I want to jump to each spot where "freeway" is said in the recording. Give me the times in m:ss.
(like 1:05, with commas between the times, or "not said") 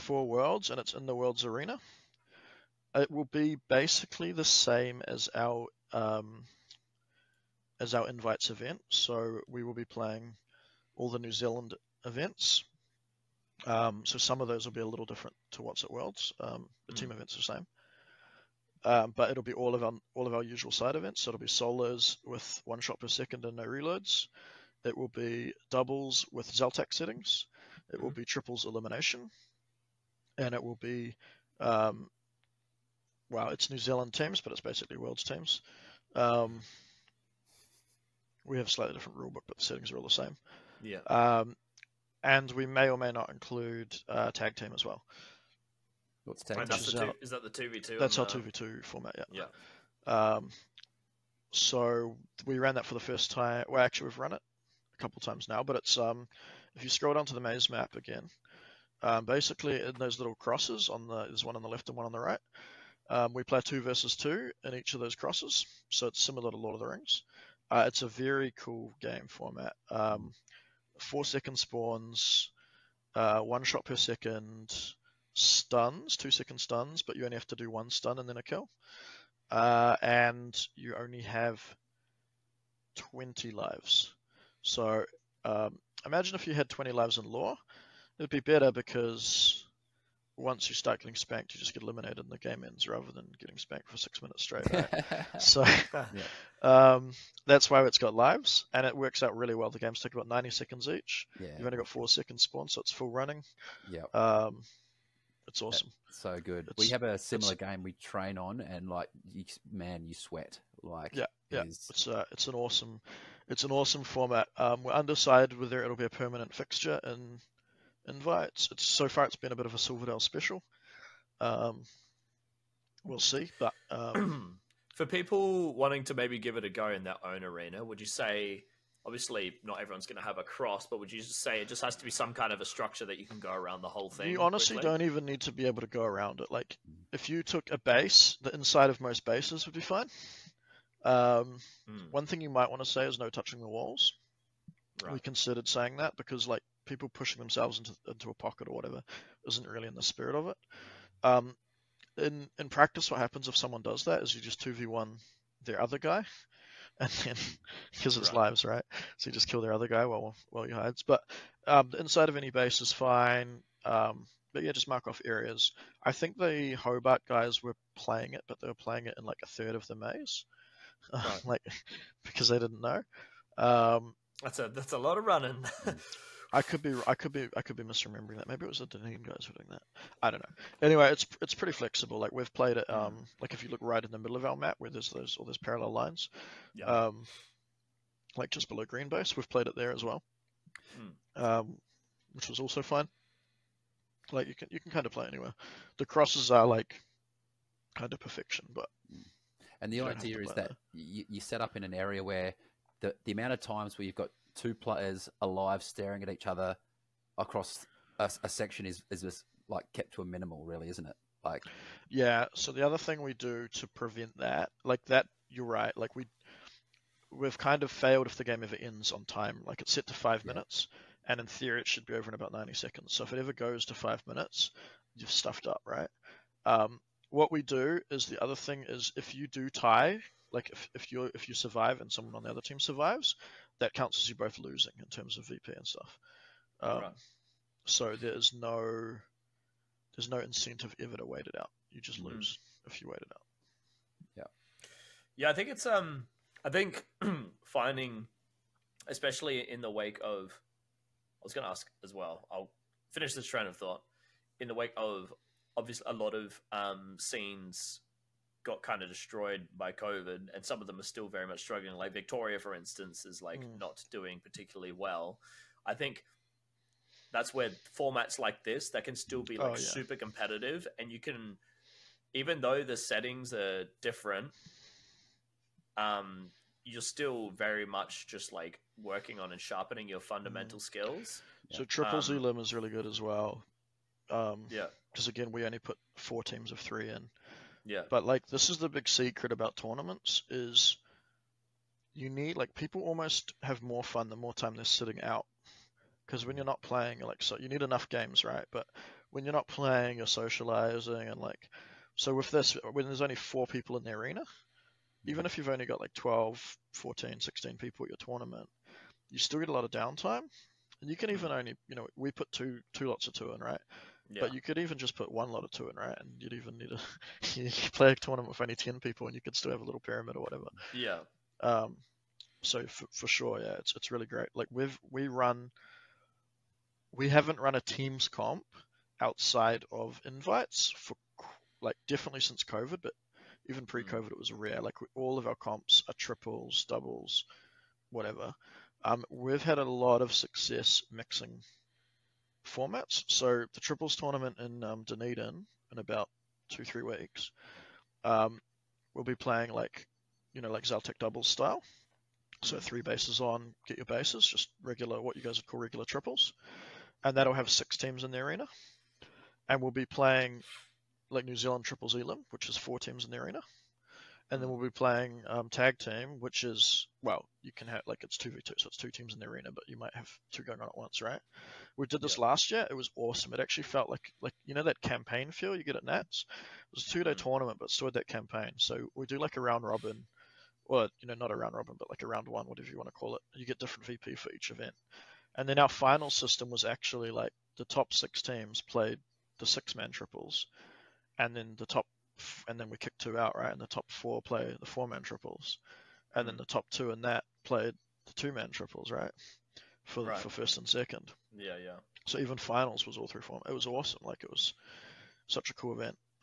not said.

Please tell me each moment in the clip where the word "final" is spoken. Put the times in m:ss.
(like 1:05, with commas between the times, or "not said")
6:25, 6:42.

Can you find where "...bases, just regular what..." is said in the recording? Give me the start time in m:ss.
5:54.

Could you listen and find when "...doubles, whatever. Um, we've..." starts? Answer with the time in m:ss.
5:36.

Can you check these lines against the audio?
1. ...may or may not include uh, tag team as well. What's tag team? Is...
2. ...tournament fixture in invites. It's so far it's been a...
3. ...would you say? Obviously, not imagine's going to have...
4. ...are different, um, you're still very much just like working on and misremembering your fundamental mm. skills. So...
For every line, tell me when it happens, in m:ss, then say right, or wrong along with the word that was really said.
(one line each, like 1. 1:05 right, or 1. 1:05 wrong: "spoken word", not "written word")
1. 0:42 right
2. 1:56 wrong: "permanent", not "tournament"
3. 2:07 wrong: "everyone", not "imagine"
4. 4:33 wrong: "sharpening", not "misremembering".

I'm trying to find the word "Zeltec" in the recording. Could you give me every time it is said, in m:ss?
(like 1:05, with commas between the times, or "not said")
0:26, 5:50.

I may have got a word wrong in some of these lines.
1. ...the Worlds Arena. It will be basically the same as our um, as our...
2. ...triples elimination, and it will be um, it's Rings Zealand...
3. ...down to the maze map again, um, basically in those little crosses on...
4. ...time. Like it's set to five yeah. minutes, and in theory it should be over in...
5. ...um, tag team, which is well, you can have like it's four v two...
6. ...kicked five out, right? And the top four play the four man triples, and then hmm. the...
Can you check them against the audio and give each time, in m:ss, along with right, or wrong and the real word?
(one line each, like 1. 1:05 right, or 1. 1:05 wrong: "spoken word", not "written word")
1. 0:01 right
2. 0:28 wrong: "New", not "Rings"
3. 0:57 right
4. 3:39 right
5. 6:05 wrong: "two", not "four"
6. 6:32 wrong: "two", not "five".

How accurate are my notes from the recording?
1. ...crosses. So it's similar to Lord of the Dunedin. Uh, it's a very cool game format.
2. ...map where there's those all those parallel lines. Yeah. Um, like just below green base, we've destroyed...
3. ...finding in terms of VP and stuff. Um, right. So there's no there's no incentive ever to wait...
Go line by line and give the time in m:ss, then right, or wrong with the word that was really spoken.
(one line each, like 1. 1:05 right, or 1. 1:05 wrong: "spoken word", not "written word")
1. 1:05 wrong: "Rings", not "Dunedin"
2. 3:04 wrong: "played", not "destroyed"
3. 3:54 wrong: "losing", not "finding".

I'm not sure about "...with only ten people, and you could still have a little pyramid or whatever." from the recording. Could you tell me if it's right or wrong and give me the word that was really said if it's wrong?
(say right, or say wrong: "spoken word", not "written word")
right.